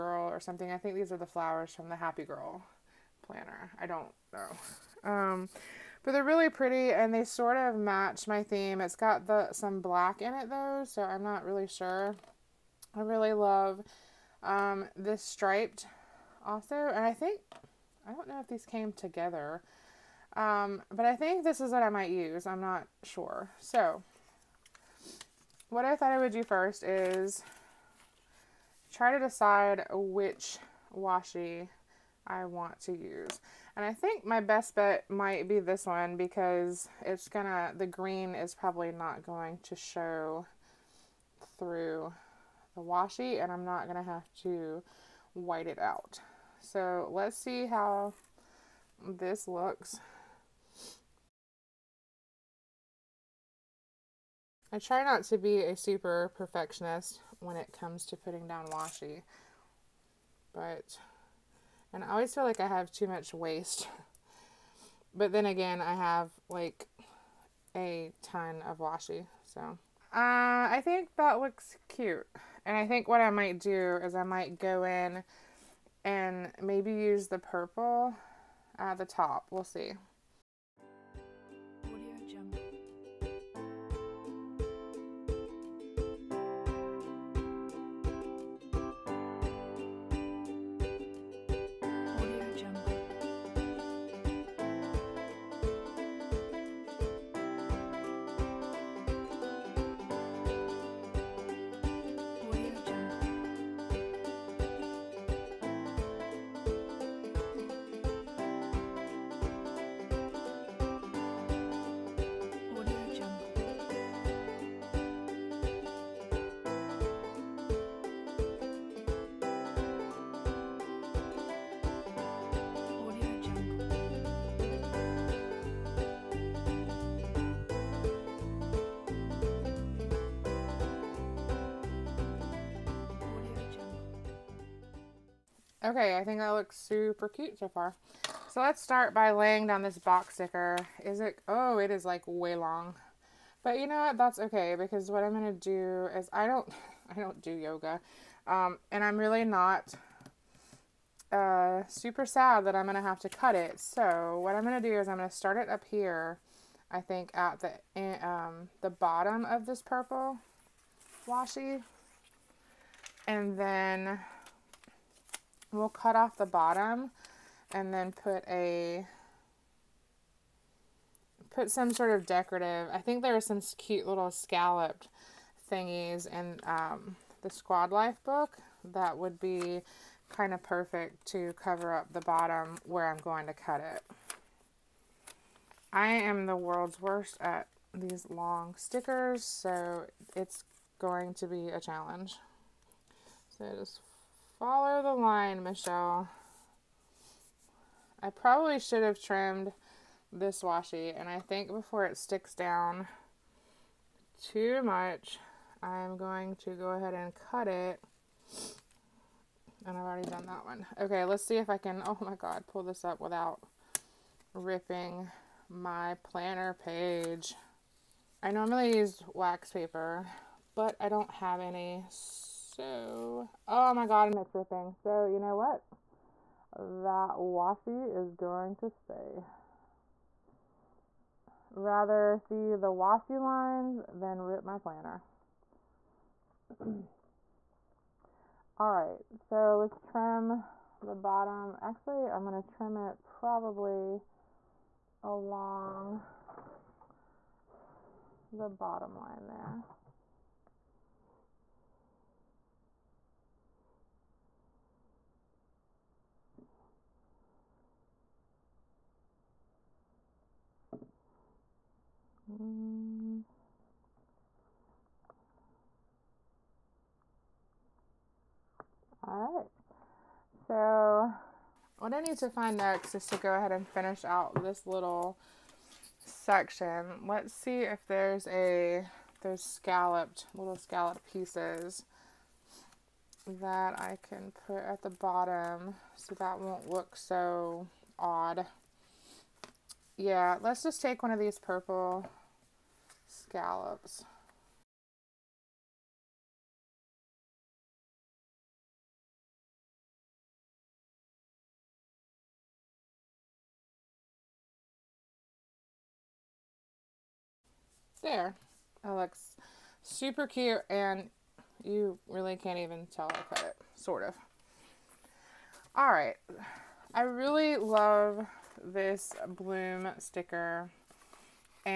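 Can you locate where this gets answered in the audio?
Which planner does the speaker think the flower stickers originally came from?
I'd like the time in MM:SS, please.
00:01.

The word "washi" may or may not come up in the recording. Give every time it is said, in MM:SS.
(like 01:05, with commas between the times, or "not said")
00:30, 00:42, 00:58, 01:08, 02:41, 03:20, 03:47, 03:52.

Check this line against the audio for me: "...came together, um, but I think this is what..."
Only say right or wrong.
right.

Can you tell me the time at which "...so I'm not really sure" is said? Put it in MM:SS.
00:10.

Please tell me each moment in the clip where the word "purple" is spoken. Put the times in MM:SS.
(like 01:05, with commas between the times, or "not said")
01:17, 02:39, 04:51.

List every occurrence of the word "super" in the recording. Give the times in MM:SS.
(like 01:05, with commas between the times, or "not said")
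00:55, 02:16, 02:31, 05:10.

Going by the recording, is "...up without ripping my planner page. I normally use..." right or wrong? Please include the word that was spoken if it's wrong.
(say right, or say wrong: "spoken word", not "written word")
right.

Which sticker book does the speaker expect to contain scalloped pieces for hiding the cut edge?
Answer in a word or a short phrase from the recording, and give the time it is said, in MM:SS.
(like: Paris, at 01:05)
Squad Life, at 02:57.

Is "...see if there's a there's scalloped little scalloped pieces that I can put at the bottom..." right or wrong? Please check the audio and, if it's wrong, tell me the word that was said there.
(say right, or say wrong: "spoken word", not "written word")
right.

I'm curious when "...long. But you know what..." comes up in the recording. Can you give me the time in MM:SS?
02:22.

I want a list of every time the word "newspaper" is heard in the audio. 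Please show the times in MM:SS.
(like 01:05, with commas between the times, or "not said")
not said.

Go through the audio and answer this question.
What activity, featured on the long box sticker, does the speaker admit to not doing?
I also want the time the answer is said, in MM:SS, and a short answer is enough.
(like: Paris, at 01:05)
Yoga, at 02:27.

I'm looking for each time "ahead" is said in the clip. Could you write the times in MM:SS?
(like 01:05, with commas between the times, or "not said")
03:26, 04:33.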